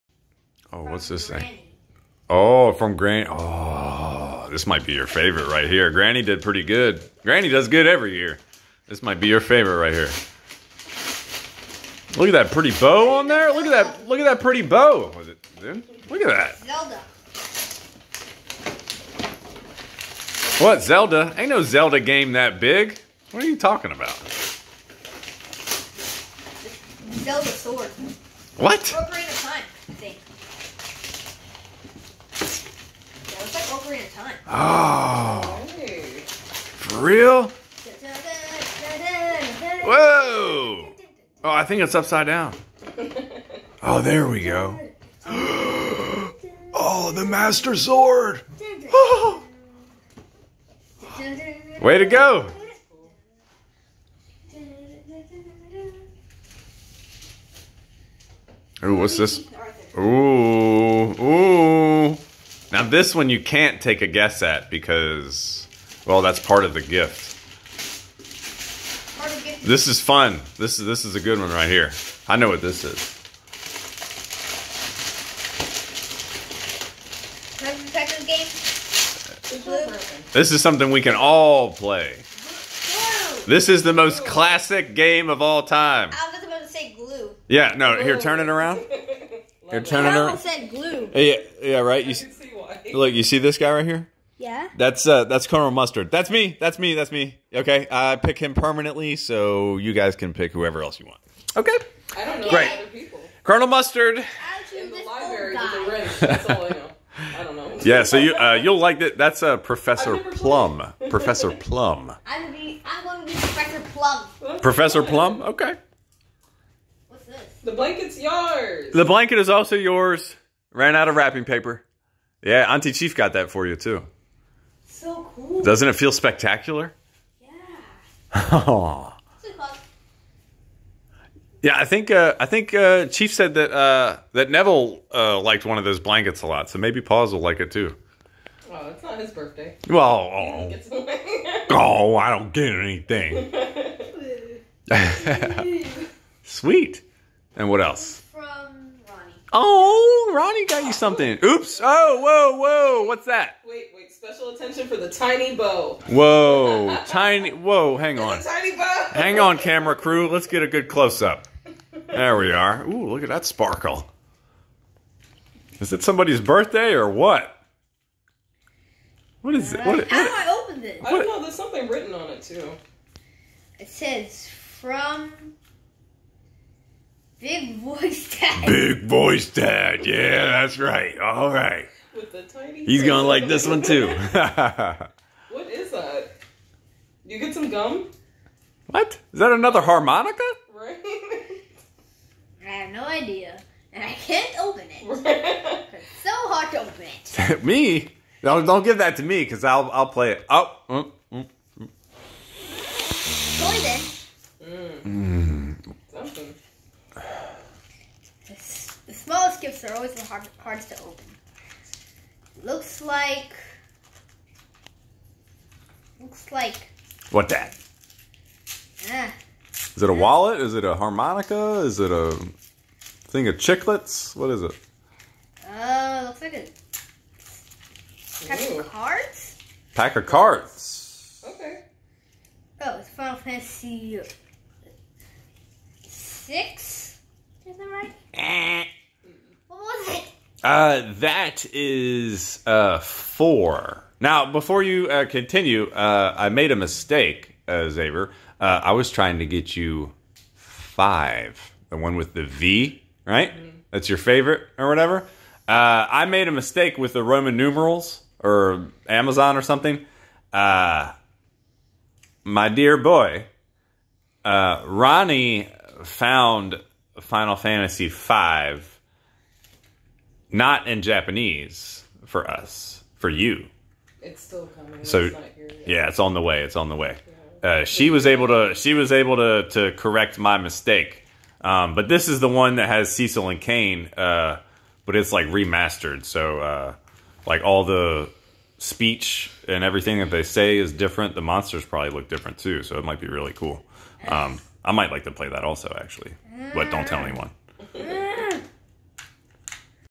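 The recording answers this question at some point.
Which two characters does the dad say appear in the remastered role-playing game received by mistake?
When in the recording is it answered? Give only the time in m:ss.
4:43.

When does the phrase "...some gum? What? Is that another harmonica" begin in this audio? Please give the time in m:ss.
3:07.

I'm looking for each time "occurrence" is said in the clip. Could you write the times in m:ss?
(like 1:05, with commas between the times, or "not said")
not said.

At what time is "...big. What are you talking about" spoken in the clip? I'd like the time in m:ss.
0:22.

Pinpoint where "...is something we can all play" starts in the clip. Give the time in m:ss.
1:20.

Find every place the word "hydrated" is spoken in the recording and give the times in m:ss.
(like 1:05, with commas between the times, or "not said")
not said.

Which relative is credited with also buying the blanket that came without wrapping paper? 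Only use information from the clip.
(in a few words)
Auntie Chief.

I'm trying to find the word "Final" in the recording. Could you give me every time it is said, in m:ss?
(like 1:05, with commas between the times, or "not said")
3:53, 4:27.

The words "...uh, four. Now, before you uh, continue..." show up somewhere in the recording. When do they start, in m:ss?
4:02.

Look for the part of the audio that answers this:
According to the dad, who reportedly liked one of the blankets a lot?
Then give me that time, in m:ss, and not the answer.
2:14.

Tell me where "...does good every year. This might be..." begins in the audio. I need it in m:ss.
0:07.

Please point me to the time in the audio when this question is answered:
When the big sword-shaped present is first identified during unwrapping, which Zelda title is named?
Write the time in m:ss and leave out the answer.
0:33.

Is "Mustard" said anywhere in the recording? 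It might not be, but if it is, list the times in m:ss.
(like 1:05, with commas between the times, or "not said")
1:35, 1:43.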